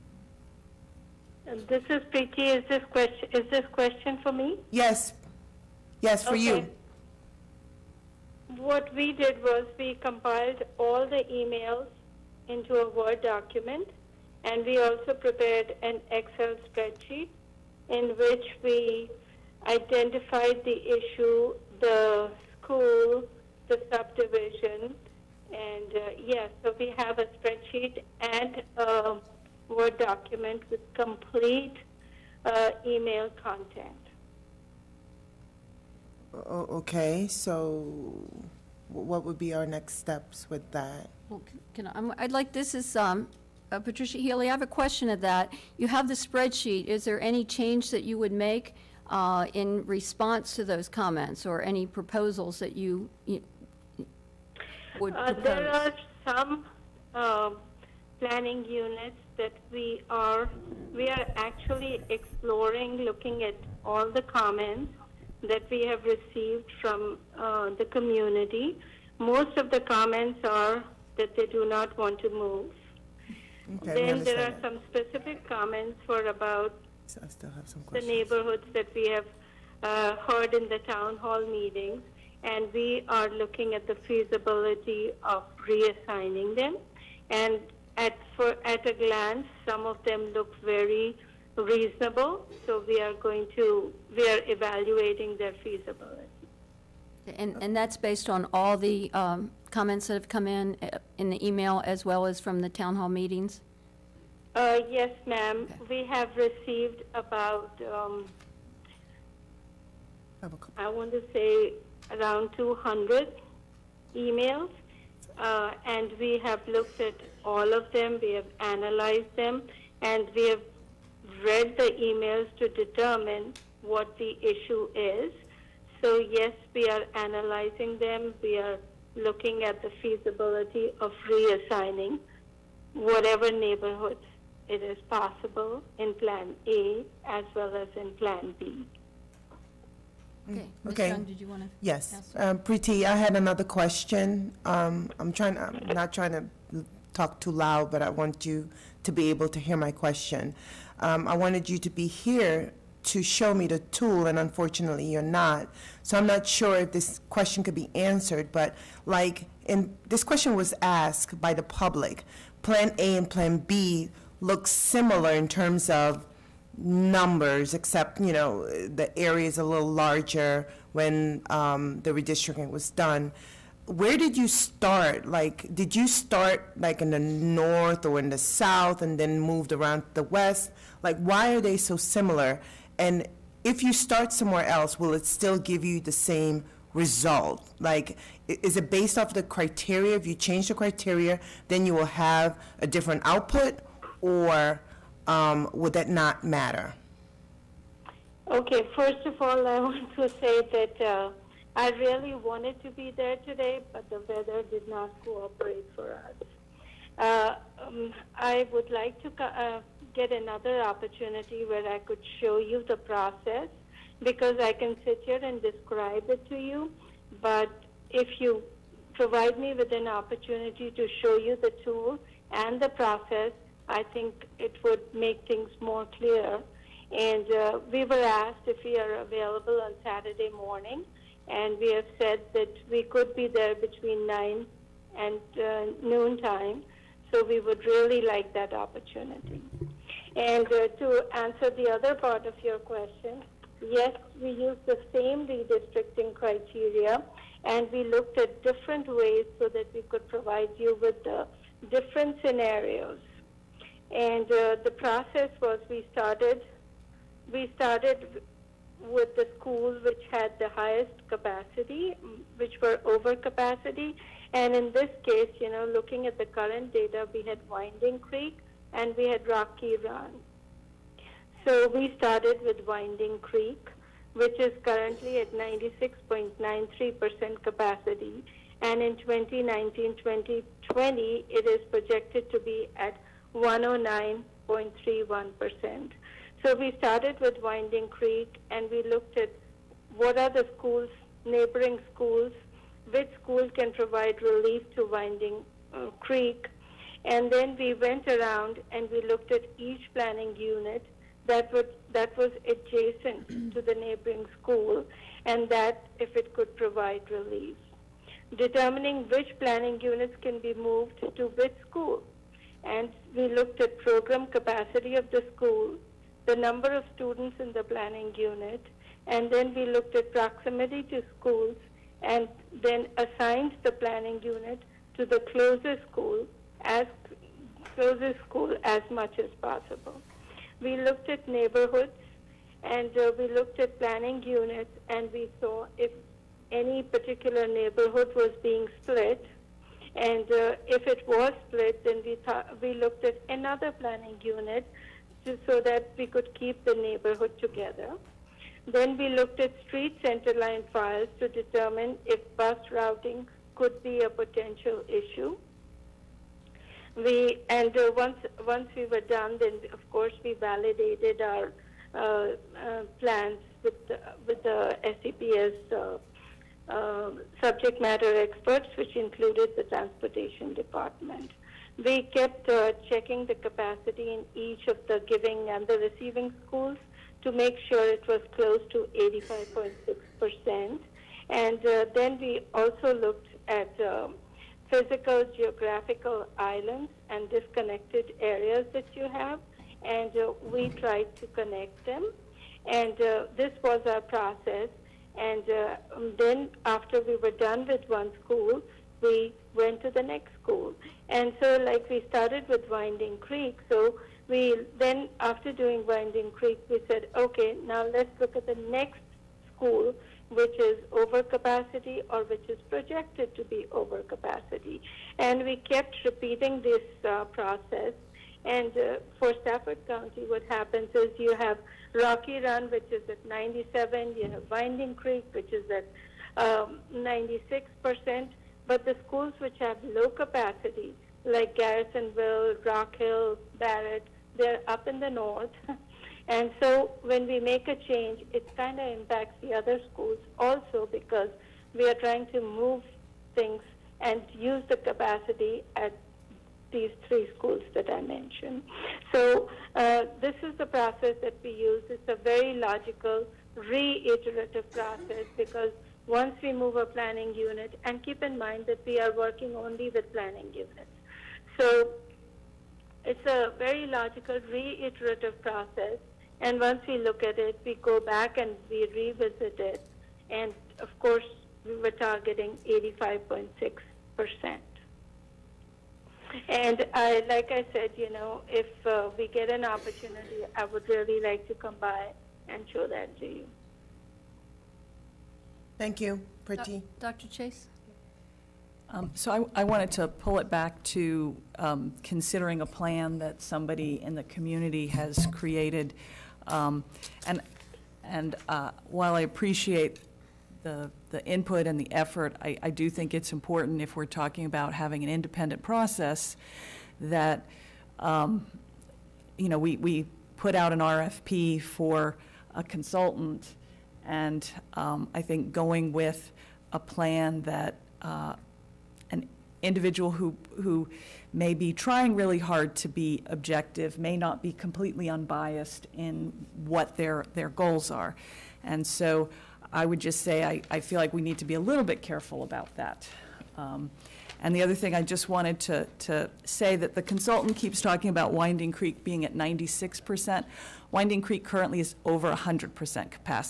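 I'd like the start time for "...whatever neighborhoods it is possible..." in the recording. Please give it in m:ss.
2:12.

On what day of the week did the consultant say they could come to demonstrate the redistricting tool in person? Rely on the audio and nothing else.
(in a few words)
Saturday.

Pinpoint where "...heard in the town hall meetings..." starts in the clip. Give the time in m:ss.
1:20.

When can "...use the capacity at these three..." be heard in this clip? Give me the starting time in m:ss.
7:24.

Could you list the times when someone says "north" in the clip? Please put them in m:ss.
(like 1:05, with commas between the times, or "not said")
2:57, 7:15.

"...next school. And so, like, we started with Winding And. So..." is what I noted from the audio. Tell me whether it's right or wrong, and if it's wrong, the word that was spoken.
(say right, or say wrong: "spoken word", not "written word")
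wrong: "Creek", not "And".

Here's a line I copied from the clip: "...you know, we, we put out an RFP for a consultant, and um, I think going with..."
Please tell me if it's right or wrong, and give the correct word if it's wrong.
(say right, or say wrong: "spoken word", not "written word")
right.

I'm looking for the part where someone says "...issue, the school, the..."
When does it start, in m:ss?
0:20.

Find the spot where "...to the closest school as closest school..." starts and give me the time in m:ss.
5:25.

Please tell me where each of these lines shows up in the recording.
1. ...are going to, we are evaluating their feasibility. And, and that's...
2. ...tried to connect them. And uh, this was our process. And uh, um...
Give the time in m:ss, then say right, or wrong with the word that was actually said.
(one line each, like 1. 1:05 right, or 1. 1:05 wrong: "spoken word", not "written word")
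1. 1:32 right
2. 6:30 right.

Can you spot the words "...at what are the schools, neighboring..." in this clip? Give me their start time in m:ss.
4:49.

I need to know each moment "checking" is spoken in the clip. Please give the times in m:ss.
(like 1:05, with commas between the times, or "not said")
6:13.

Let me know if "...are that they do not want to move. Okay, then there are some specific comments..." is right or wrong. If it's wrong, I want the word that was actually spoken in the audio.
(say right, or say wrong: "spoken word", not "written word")
right.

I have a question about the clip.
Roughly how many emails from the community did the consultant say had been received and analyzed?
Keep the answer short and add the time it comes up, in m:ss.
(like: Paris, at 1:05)
200, at 1:52.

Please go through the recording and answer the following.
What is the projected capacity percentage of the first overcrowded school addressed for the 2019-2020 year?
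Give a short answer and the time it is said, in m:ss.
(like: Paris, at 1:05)
109.31%, at 4:43.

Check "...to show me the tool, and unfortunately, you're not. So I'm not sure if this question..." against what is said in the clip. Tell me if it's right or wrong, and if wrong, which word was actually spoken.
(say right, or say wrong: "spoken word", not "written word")
right.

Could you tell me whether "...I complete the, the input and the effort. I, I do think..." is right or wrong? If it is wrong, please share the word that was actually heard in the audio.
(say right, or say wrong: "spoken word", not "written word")
wrong: "appreciate", not "complete".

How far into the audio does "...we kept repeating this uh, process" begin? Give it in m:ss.
6:55.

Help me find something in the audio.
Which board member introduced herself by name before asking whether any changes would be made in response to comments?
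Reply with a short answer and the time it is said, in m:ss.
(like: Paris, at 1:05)
Patricia Healy, at 0:43.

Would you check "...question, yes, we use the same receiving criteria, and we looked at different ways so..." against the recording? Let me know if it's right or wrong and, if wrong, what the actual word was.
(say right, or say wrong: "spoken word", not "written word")
wrong: "redistricting", not "receiving".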